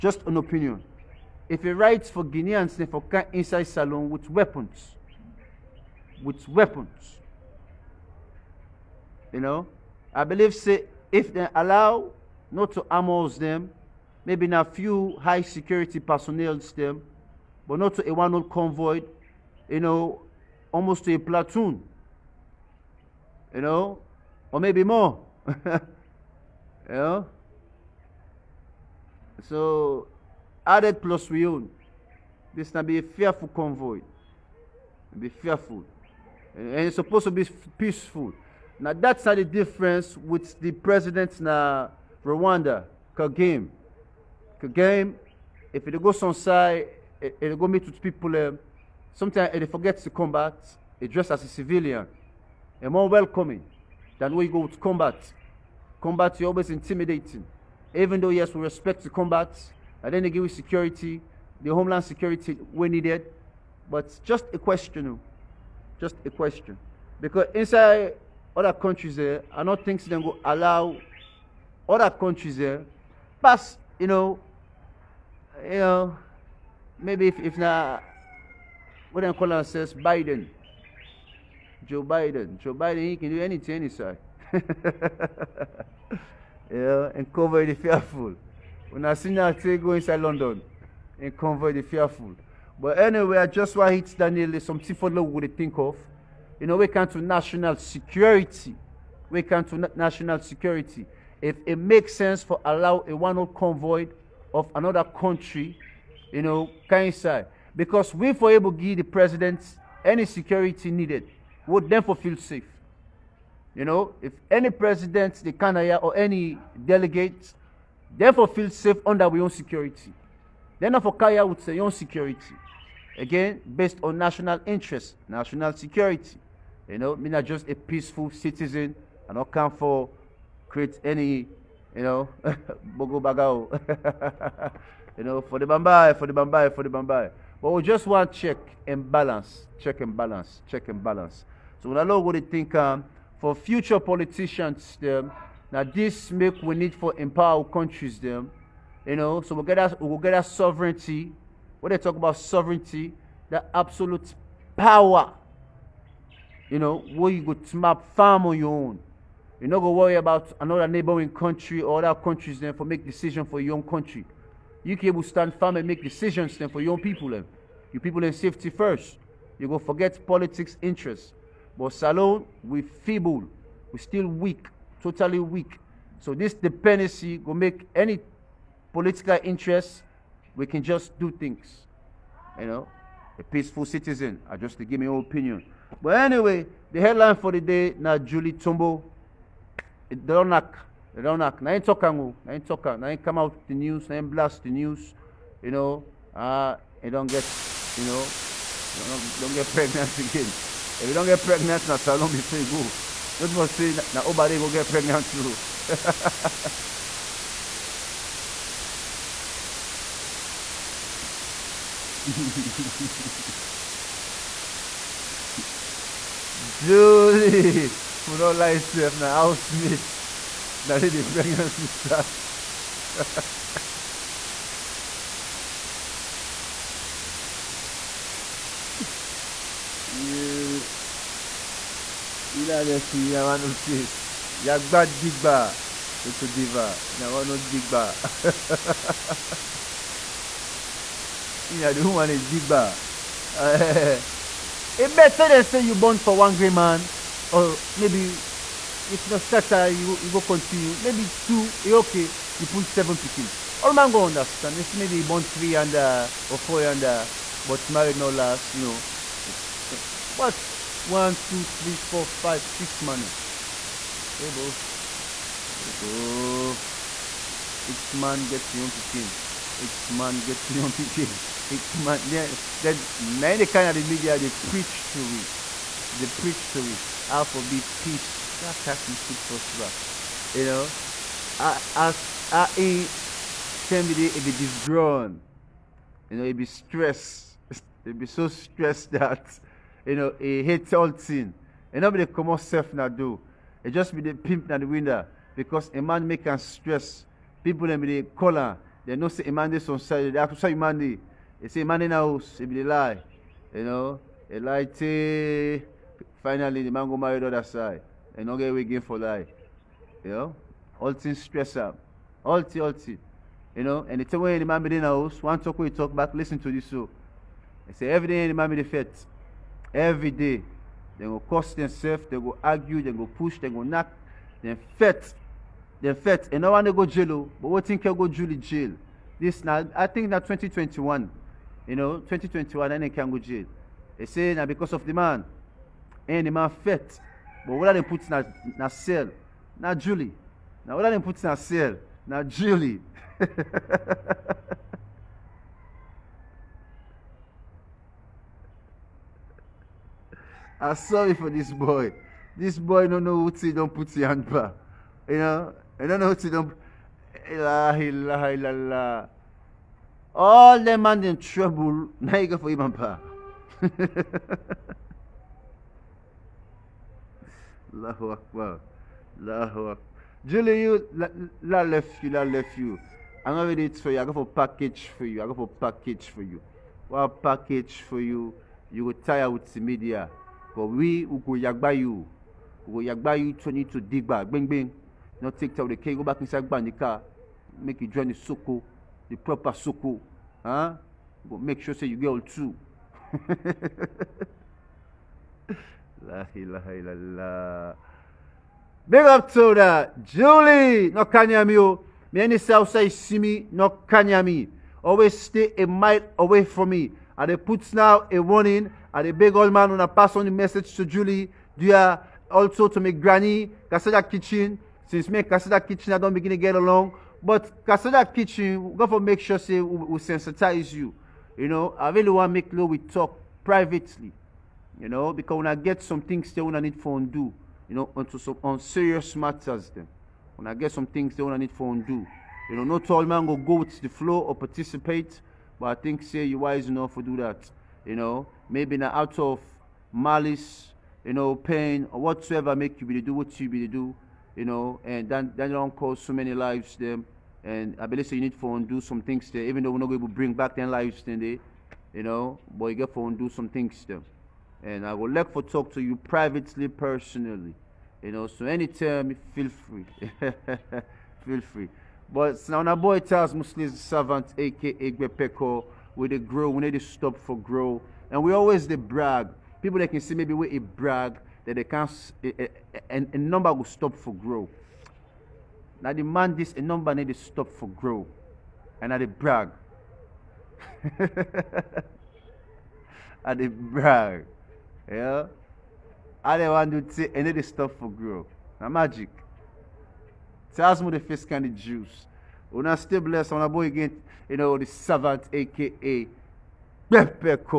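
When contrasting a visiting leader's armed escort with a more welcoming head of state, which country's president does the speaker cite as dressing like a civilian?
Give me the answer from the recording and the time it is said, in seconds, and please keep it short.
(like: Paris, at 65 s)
Rwanda, at 42 s.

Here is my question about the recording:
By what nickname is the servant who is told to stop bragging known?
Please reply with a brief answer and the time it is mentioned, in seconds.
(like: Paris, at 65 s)
Gwepeko, at 465 s.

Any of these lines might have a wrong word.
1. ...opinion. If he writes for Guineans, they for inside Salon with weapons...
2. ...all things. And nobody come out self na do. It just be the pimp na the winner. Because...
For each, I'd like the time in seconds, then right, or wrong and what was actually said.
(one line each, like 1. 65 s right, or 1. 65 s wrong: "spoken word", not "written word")
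1. 0 s right
2. 290 s right.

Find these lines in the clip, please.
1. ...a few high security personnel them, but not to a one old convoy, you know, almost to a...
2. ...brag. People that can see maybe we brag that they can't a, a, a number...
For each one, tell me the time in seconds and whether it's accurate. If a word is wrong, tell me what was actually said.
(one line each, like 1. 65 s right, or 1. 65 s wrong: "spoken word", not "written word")
1. 14 s right
2. 468 s right.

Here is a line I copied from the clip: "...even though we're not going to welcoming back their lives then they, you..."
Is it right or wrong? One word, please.
wrong.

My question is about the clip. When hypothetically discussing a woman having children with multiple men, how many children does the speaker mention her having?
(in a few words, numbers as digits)
7.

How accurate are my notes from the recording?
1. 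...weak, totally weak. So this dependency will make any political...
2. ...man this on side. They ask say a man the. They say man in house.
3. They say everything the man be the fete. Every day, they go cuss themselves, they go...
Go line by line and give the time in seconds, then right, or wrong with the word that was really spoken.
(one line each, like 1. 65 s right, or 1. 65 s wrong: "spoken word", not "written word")
1. 174 s right
2. 299 s right
3. 317 s right.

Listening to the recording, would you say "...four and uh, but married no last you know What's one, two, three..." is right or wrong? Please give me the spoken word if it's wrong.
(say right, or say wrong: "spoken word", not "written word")
right.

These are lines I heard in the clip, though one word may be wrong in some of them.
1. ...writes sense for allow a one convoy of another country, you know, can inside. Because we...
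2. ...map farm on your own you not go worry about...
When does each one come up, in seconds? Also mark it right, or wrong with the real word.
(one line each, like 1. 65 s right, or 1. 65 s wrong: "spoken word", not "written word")
1. 101 s wrong: "makes", not "writes"
2. 157 s right.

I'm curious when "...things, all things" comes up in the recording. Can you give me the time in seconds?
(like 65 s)
312 s.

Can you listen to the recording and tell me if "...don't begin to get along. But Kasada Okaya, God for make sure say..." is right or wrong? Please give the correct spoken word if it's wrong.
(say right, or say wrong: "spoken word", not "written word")
wrong: "Kitchen", not "Okaya".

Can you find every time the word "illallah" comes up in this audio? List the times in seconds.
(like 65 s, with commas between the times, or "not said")
358 s, 396 s.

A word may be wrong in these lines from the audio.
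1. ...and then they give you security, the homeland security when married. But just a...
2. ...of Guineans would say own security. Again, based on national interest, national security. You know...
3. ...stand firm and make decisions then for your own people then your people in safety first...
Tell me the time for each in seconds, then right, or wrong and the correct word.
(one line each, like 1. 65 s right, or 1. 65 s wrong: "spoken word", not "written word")
1. 60 s wrong: "needed", not "married"
2. 120 s wrong: "Okaya", not "Guineans"
3. 165 s right.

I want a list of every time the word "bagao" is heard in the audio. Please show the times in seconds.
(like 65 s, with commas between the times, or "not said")
133 s.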